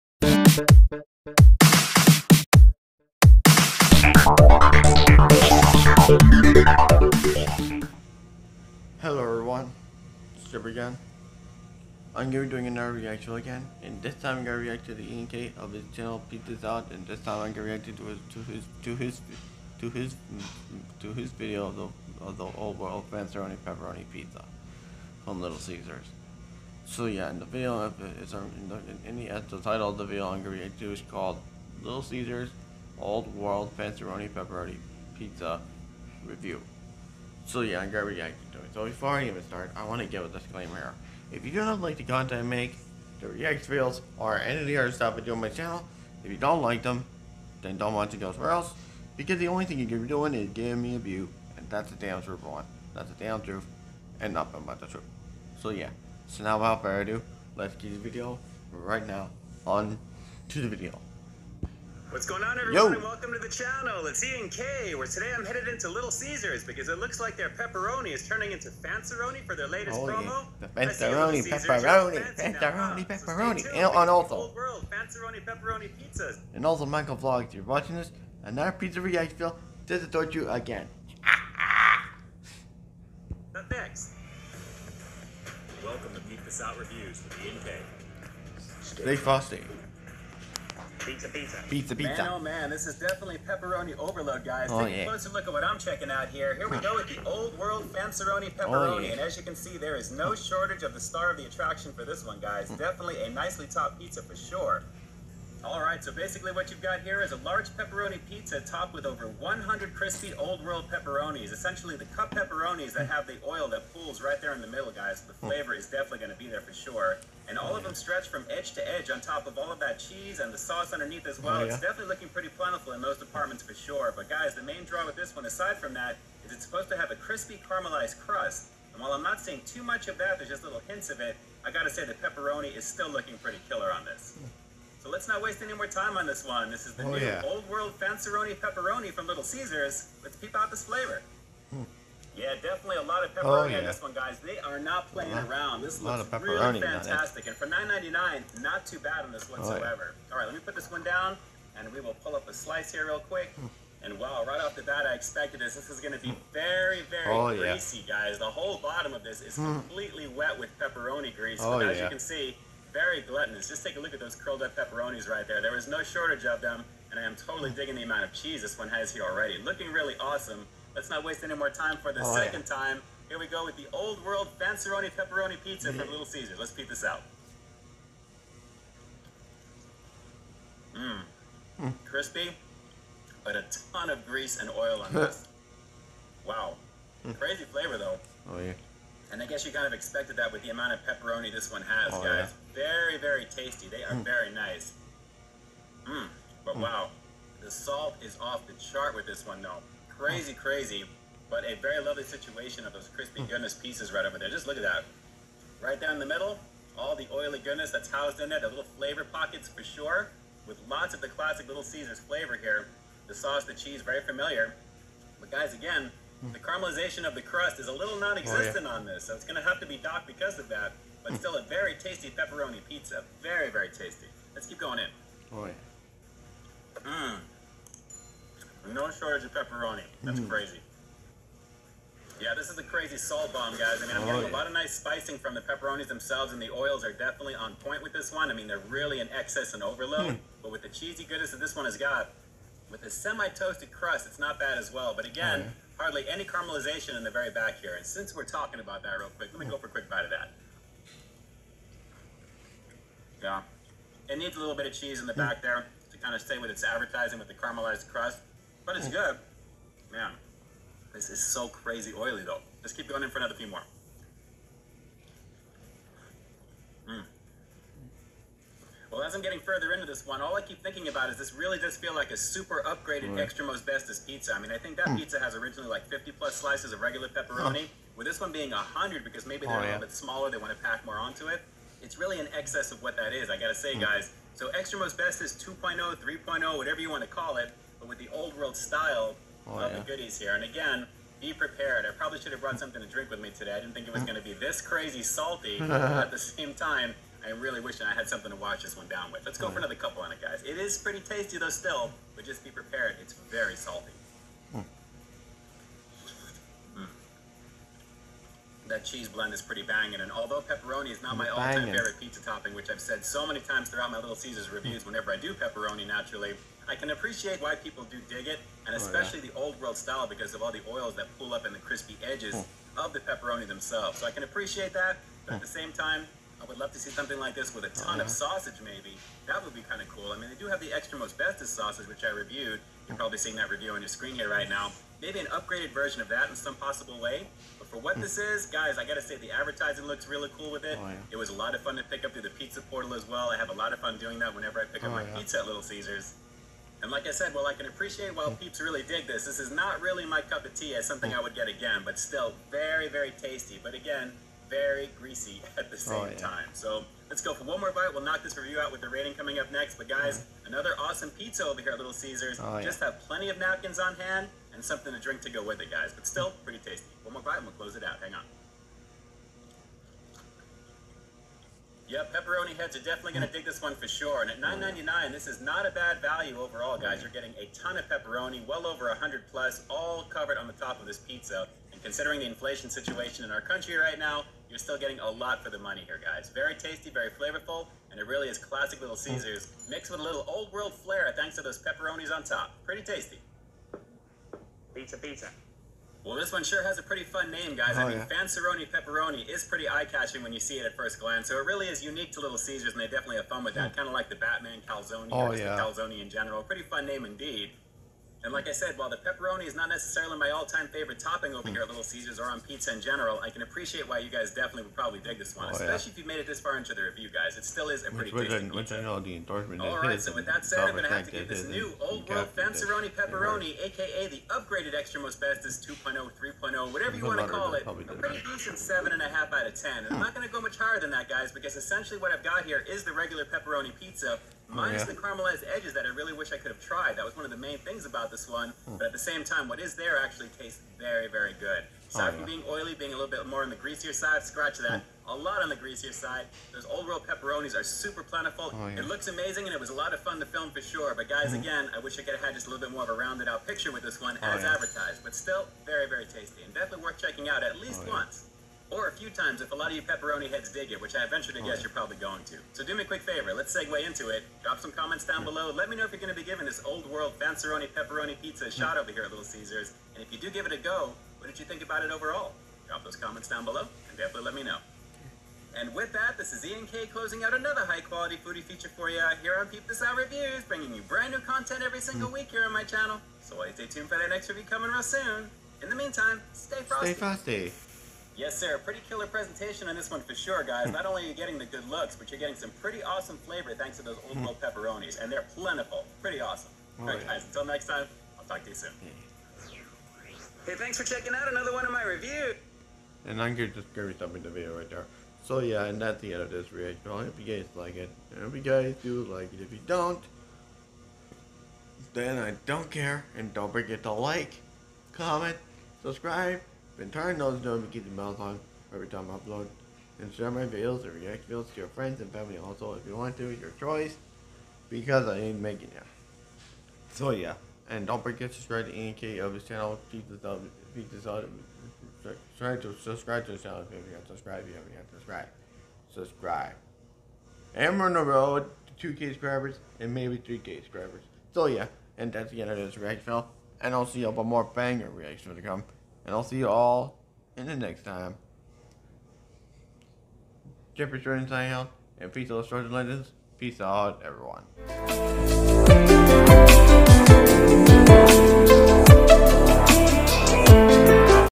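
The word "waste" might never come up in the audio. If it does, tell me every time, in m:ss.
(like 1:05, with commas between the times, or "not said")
2:15, 2:51.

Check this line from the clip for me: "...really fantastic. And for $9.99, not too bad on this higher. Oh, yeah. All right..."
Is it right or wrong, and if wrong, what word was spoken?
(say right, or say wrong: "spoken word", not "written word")
wrong: "whatsoever", not "higher".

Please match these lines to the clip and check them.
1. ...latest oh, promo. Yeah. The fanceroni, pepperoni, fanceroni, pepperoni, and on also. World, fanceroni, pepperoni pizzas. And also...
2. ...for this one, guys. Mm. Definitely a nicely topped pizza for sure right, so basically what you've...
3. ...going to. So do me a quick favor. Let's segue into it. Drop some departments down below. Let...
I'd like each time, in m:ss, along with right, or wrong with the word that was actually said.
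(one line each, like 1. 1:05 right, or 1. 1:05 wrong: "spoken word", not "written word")
1. 1:09 right
2. 1:41 right
3. 7:42 wrong: "comments", not "departments".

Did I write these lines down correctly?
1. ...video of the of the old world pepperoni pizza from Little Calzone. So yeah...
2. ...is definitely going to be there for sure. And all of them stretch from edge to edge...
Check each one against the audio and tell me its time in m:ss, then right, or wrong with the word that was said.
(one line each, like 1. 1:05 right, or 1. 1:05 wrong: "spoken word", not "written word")
1. 0:21 wrong: "Caesars", not "Calzone"
2. 1:55 right.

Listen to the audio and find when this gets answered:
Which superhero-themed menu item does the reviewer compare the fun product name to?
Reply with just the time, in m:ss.
6:44.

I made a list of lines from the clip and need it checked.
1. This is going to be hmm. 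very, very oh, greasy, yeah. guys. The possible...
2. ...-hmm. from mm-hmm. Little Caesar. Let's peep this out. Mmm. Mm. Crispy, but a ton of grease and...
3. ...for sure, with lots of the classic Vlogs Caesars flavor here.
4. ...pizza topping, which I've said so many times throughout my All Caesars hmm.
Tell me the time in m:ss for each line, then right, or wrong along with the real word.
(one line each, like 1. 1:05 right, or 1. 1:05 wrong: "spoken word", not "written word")
1. 2:35 wrong: "whole", not "possible"
2. 2:55 right
3. 3:29 wrong: "Little", not "Vlogs"
4. 5:12 wrong: "Little", not "All".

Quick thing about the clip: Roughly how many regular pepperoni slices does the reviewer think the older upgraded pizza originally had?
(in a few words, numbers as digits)
50 plus.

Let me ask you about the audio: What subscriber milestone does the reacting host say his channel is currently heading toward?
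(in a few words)
2K.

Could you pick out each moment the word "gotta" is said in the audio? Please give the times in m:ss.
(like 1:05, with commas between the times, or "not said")
2:11, 4:43, 5:39.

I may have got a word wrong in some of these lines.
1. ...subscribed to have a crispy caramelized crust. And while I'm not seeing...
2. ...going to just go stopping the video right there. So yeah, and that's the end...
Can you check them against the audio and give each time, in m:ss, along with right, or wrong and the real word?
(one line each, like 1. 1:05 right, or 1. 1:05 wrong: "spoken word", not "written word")
1. 2:06 wrong: "supposed", not "subscribed"
2. 8:23 right.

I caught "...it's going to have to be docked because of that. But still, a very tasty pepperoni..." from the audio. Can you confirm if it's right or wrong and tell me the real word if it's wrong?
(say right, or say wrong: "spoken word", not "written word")
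right.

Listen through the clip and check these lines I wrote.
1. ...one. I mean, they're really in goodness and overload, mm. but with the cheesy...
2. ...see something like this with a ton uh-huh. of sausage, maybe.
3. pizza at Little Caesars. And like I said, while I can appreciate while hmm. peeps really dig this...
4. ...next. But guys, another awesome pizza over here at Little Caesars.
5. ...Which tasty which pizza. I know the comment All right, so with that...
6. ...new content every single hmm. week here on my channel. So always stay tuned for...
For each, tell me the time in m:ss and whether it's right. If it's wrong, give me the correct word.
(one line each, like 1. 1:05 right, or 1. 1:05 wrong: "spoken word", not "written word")
1. 3:58 wrong: "excess", not "goodness"
2. 5:26 right
3. 5:45 right
4. 5:59 right
5. 6:58 wrong: "endorsement", not "comment"
6. 8:01 right.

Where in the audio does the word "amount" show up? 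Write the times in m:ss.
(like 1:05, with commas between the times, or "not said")
2:48, 3:10.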